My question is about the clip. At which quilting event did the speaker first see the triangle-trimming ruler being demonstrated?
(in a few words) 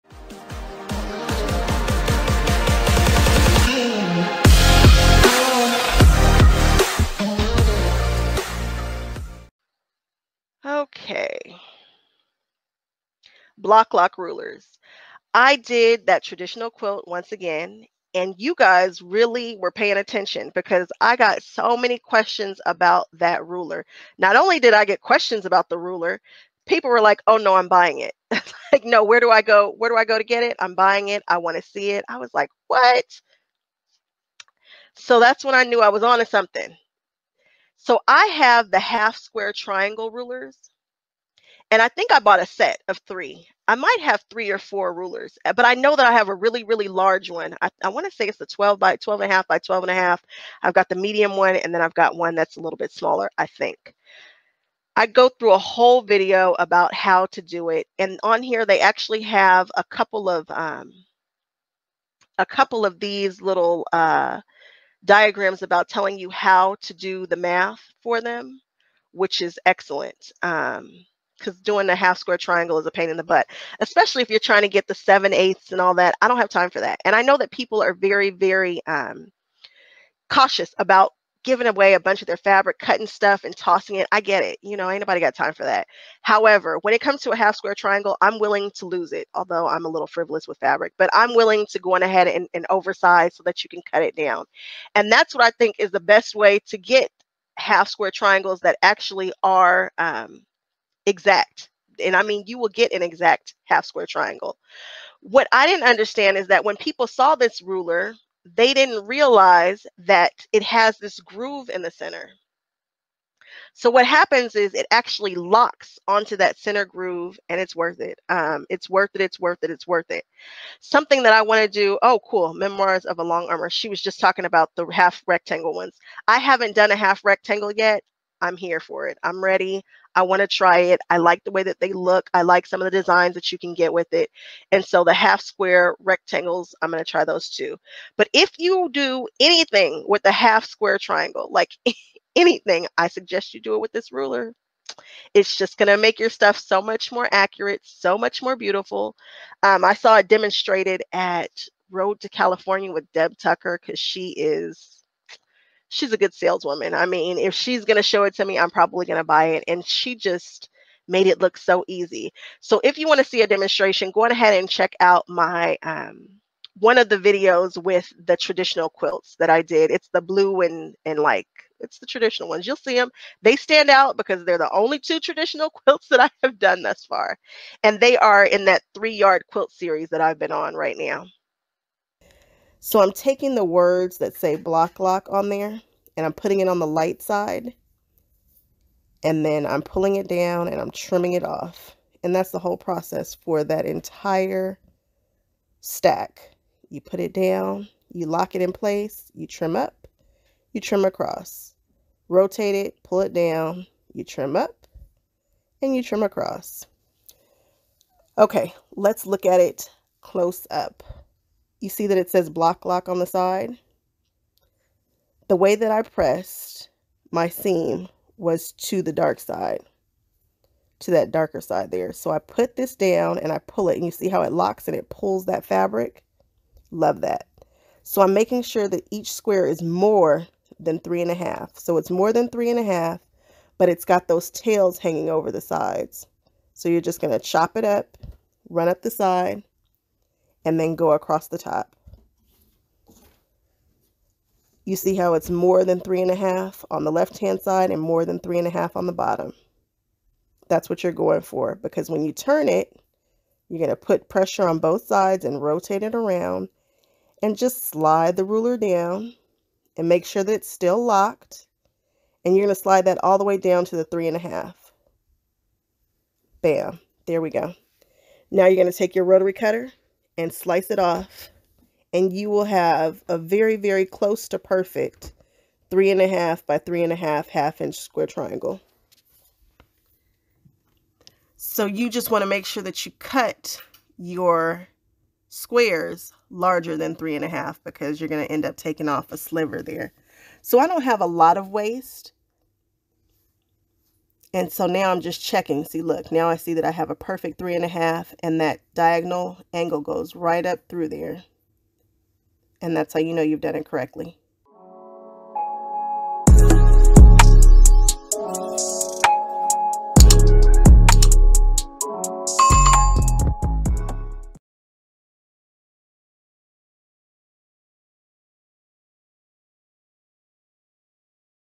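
Road to California.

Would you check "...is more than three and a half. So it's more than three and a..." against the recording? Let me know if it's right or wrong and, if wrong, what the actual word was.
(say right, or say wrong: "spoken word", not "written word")
right.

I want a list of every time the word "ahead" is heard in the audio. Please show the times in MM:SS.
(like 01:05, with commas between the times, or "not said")
01:32, 02:44.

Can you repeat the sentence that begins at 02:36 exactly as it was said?
I mean, if she's going to show it to me, I'm probably going to buy it.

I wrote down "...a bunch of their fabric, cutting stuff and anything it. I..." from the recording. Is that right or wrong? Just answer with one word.
wrong.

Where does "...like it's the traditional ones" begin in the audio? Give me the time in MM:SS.
02:51.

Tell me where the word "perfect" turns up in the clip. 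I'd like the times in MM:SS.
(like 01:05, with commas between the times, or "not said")
04:34, 04:57.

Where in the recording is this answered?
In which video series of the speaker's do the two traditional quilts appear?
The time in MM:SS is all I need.
02:58.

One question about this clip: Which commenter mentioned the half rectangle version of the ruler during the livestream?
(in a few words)
Memoirs of a Long Armor.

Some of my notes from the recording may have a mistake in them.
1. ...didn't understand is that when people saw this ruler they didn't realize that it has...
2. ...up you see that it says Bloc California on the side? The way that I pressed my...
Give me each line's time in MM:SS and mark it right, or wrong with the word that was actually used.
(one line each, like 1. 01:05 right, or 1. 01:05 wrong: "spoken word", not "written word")
1. 01:45 right
2. 03:30 wrong: "Loc", not "California".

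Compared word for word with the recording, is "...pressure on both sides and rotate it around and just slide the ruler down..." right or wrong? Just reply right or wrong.
right.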